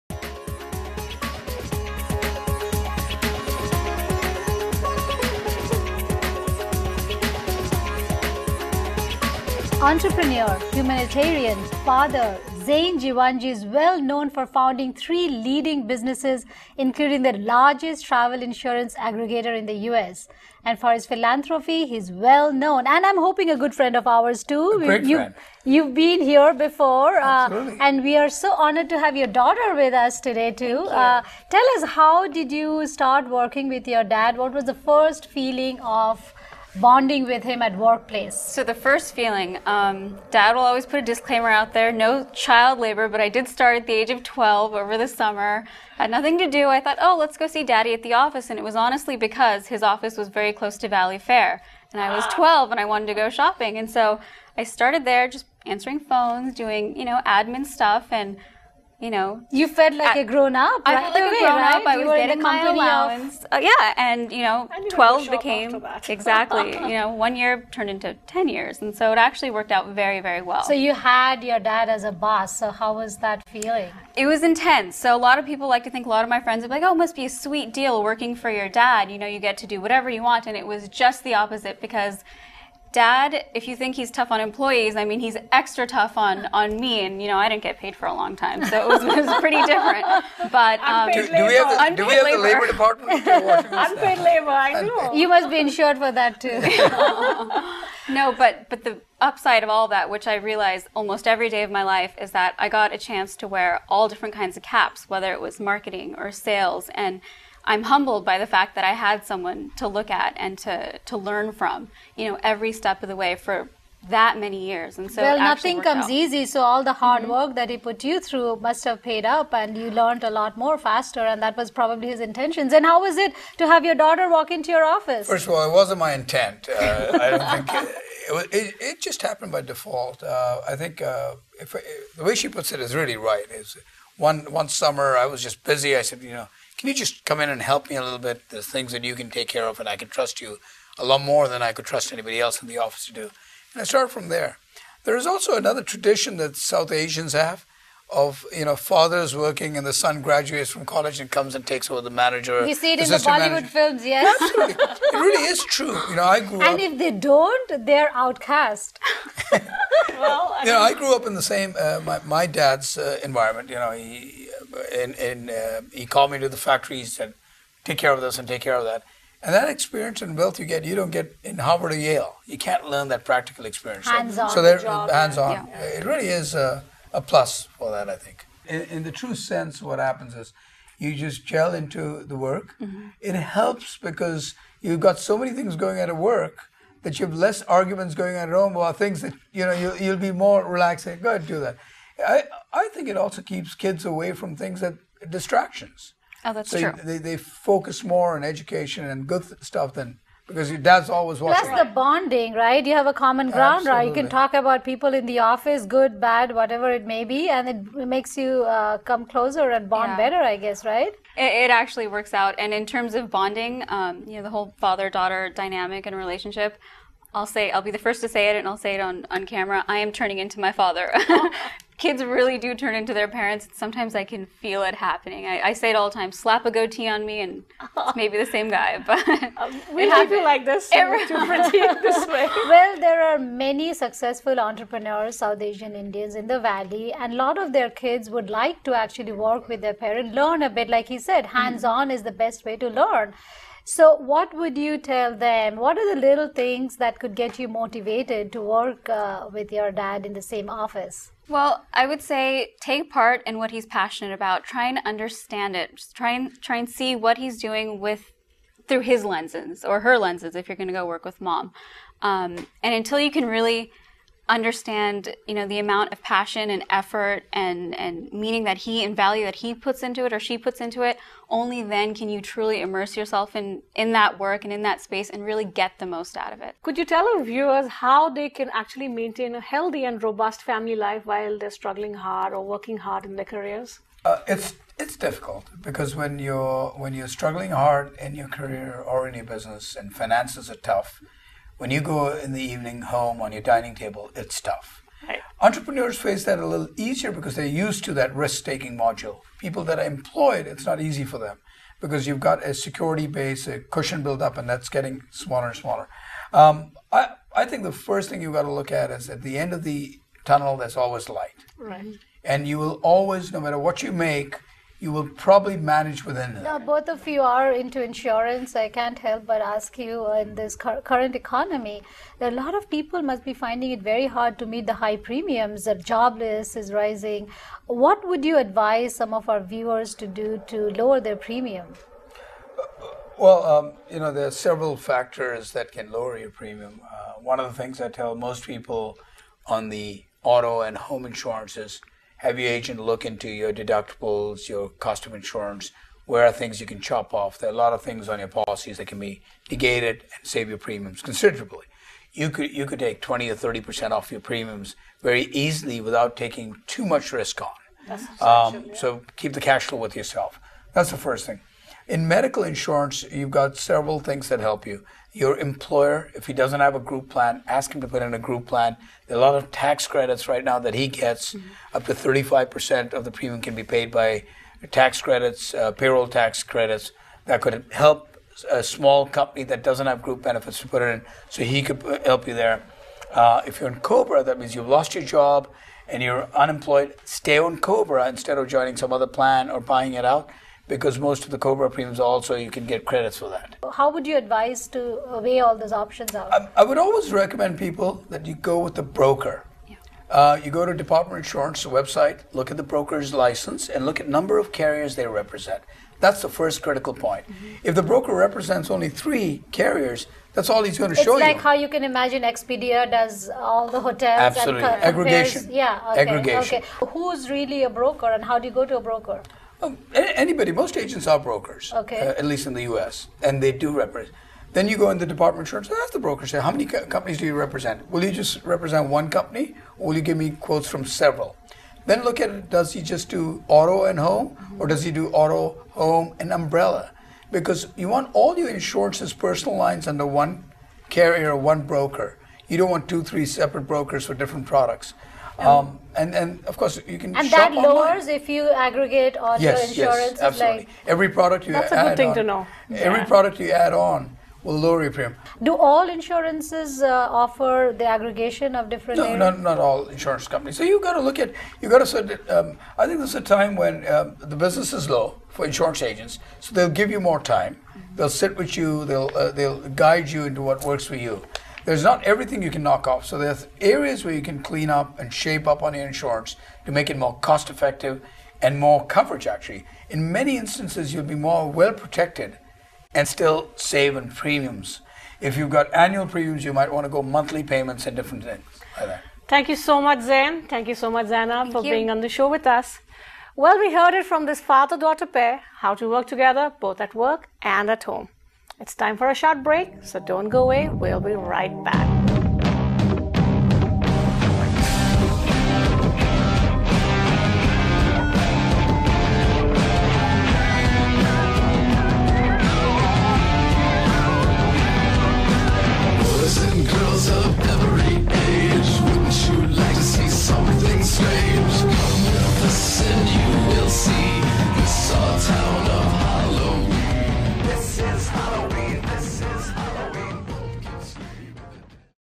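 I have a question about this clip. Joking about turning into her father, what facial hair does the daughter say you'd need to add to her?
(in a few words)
a goatee.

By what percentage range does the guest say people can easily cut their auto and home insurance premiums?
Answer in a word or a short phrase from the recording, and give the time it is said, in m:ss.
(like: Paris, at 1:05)
20 or 30 percent, at 5:53.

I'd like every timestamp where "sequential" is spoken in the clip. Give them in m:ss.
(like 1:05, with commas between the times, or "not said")
not said.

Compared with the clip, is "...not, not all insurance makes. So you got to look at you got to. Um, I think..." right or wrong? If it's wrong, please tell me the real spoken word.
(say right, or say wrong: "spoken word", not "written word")
wrong: "companies", not "makes".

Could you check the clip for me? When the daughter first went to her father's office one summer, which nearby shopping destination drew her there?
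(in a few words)
Valley Fair.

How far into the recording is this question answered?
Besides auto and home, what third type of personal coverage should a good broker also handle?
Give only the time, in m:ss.
7:16.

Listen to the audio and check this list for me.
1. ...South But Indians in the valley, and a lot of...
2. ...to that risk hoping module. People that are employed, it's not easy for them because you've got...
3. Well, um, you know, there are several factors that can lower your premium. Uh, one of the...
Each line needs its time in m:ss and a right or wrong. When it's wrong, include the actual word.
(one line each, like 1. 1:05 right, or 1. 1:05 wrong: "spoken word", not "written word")
1. 3:55 wrong: "Asian", not "But"
2. 4:58 wrong: "taking", not "hoping"
3. 5:33 right.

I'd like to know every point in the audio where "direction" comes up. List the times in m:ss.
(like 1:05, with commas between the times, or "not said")
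not said.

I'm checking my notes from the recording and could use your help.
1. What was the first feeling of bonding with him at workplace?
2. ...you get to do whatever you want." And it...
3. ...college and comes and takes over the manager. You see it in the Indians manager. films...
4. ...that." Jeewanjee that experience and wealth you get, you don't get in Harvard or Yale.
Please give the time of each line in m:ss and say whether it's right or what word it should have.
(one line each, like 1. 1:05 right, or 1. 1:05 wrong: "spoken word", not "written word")
1. 0:34 right
2. 1:19 right
3. 2:30 wrong: "Bollywood", not "Indians"
4. 2:48 wrong: "And", not "Jeewanjee".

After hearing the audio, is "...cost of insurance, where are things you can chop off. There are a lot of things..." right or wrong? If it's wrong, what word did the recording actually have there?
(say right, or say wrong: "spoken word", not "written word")
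right.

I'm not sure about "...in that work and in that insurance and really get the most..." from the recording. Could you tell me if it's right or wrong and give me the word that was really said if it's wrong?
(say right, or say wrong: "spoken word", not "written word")
wrong: "space", not "insurance".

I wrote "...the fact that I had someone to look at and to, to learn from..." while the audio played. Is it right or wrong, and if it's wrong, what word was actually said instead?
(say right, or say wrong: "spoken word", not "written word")
right.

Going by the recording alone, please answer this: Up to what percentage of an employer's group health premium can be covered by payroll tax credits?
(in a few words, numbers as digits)
35%.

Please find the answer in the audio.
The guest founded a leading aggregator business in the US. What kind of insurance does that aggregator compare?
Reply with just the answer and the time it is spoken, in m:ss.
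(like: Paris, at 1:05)
travel insurance, at 0:18.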